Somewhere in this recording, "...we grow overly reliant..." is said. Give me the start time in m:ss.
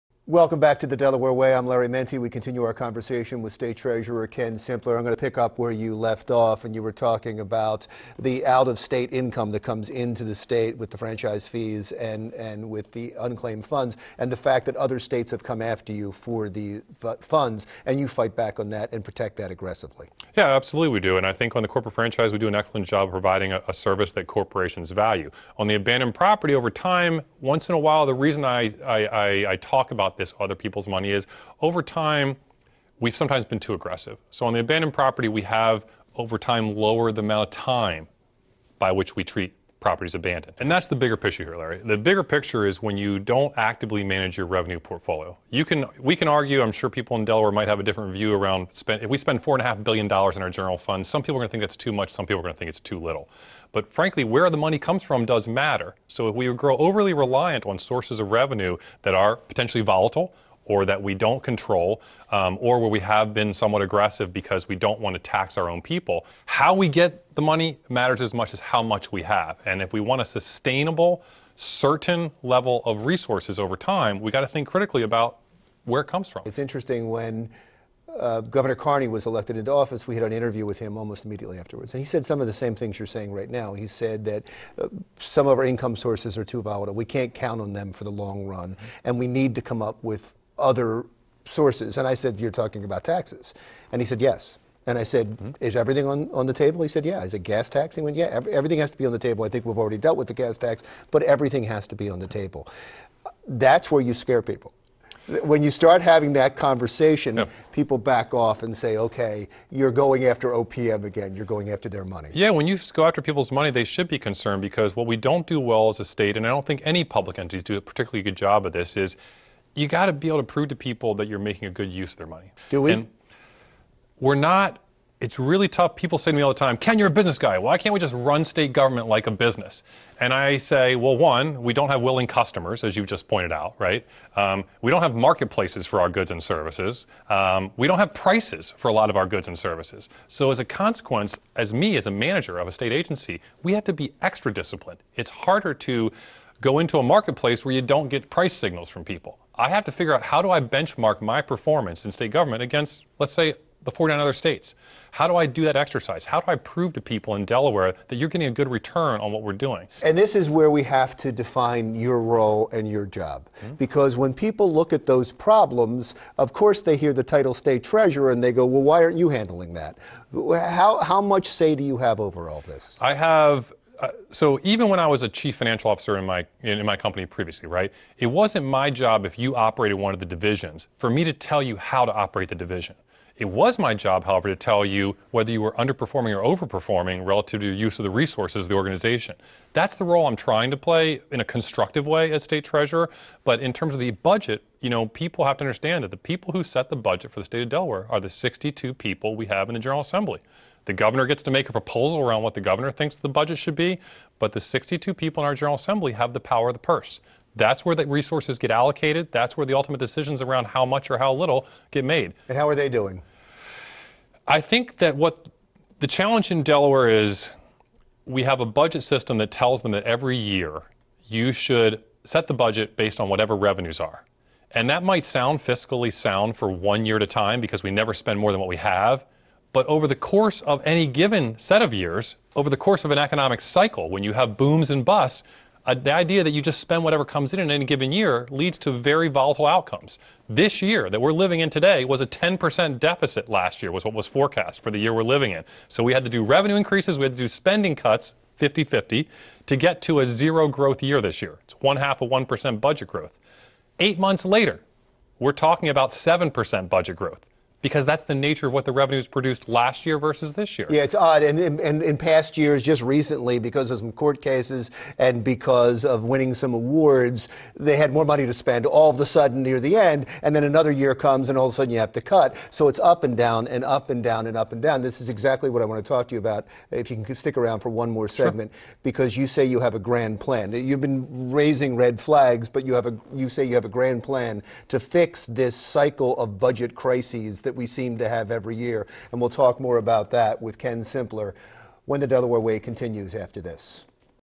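0:56.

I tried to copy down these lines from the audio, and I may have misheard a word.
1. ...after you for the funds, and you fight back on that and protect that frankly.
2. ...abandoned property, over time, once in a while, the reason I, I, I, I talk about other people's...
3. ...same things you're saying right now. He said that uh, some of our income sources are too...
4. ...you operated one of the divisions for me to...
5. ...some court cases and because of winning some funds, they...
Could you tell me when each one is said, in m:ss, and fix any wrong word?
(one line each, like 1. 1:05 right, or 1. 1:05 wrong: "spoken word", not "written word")
1. 0:15 wrong: "aggressively", not "frankly"
2. 0:25 right
3. 1:22 right
4. 2:59 right
5. 4:23 wrong: "awards", not "funds".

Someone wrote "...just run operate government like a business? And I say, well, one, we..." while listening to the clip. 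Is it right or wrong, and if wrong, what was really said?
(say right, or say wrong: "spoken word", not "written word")
wrong: "state", not "operate".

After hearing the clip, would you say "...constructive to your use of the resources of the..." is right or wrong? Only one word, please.
wrong.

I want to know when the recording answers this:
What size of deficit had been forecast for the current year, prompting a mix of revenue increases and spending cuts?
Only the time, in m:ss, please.
4:02.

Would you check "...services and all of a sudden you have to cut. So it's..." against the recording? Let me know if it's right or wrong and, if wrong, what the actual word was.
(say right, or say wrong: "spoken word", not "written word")
wrong: "comes", not "services".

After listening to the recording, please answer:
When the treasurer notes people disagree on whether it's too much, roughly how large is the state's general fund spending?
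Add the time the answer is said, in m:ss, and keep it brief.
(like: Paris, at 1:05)
4.5 billion dollars, at 0:49.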